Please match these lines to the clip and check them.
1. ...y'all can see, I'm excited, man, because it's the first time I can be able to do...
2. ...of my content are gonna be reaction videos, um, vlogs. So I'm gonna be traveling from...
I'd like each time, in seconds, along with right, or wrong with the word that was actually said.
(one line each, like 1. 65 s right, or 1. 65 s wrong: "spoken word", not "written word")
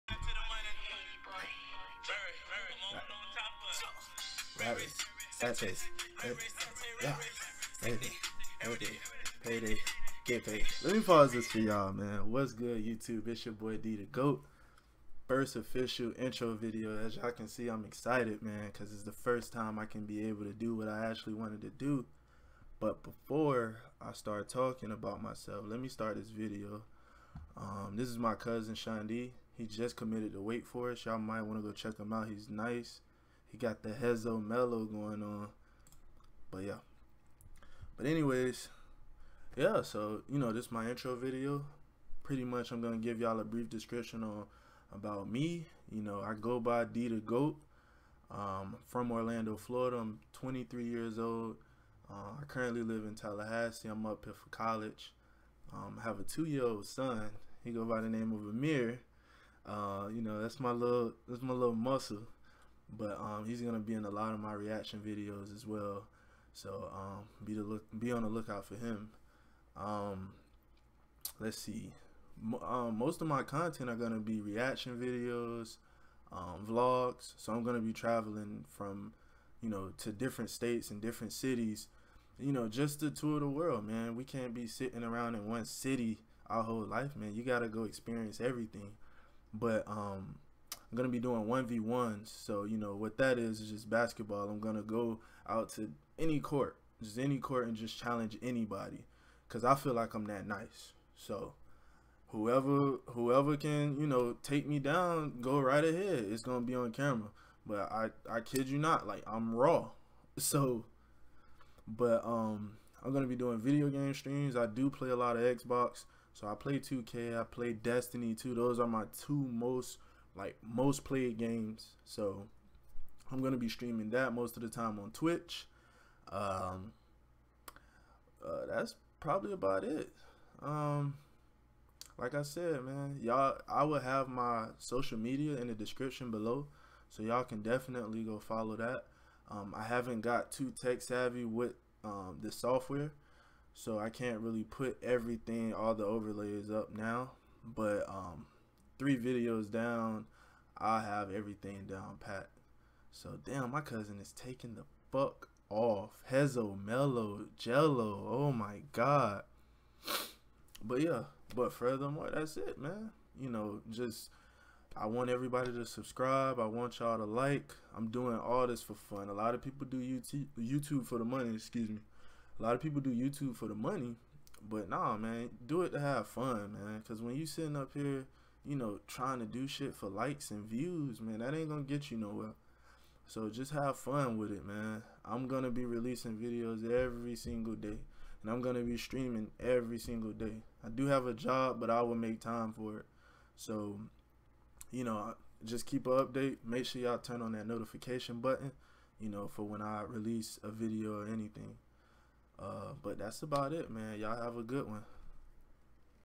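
1. 17 s right
2. 73 s right.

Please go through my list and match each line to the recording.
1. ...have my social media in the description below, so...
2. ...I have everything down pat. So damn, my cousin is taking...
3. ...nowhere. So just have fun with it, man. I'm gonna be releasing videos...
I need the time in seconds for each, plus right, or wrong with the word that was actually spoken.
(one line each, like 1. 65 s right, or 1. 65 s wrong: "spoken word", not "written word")
1. 133 s right
2. 150 s right
3. 182 s right.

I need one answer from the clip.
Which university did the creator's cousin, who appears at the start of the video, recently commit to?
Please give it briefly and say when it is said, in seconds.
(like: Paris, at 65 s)
Wake Forest, at 30 s.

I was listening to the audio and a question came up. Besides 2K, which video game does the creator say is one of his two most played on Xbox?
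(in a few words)
Destiny 2.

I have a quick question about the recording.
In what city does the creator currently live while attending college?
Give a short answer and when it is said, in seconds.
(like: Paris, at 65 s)
Tallahassee, at 53 s.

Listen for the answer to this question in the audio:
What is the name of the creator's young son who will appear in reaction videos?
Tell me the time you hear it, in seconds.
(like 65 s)
58 s.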